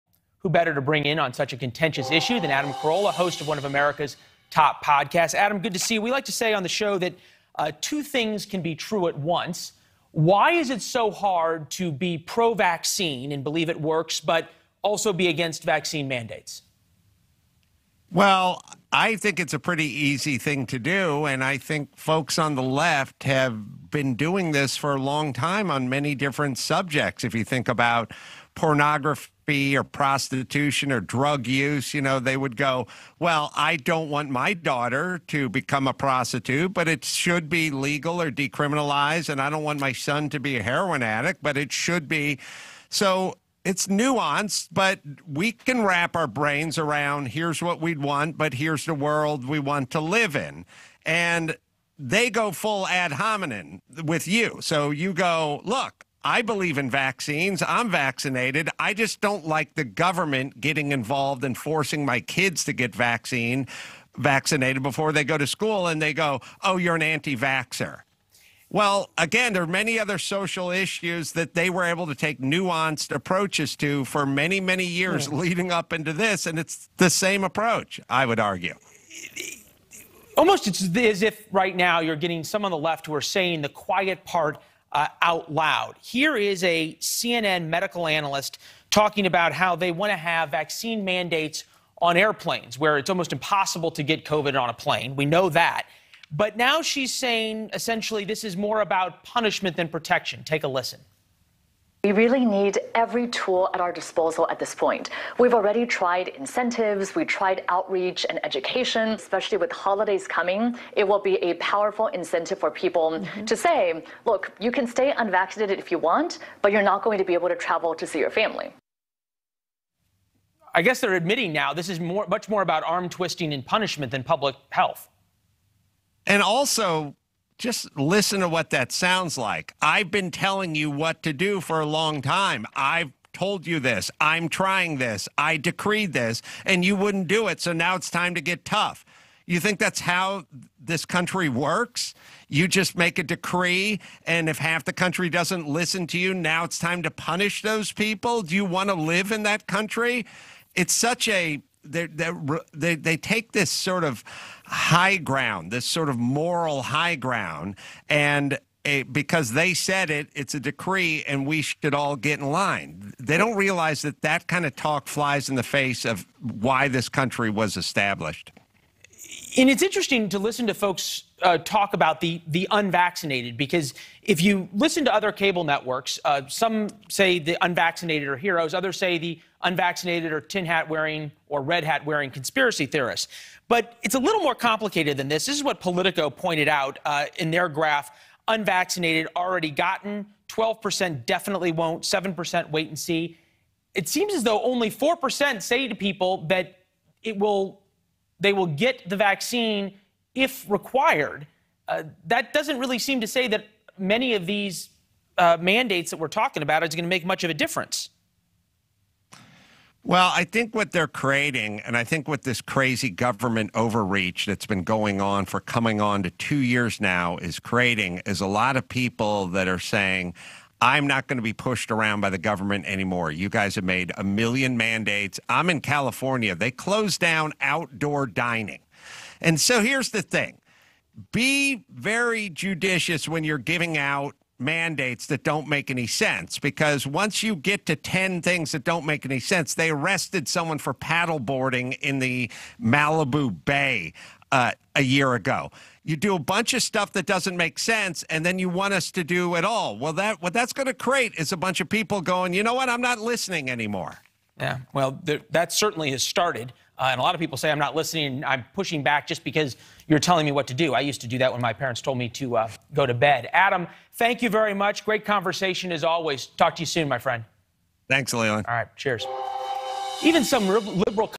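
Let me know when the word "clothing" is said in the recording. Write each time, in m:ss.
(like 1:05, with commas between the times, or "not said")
not said.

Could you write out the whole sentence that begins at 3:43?
You guys have made a million mandates.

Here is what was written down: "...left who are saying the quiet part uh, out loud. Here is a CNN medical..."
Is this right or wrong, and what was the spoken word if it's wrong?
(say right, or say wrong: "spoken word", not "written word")
right.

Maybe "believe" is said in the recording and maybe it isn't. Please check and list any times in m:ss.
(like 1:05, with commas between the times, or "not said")
0:13, 0:56.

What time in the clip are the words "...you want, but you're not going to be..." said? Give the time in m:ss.
1:55.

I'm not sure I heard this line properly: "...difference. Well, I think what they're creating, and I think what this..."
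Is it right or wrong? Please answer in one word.
right.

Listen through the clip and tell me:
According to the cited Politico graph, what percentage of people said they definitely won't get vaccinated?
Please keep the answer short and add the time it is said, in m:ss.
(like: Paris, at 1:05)
12%, at 3:10.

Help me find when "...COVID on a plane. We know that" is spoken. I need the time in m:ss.
1:34.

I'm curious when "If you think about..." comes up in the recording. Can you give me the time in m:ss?
0:27.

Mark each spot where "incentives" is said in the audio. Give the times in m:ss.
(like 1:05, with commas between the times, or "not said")
1:46, 1:52.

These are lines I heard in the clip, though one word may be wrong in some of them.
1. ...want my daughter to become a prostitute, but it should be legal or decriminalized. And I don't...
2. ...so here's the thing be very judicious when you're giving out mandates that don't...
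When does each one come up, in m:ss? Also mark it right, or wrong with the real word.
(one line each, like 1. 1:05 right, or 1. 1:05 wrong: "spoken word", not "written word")
1. 0:34 right
2. 3:49 right.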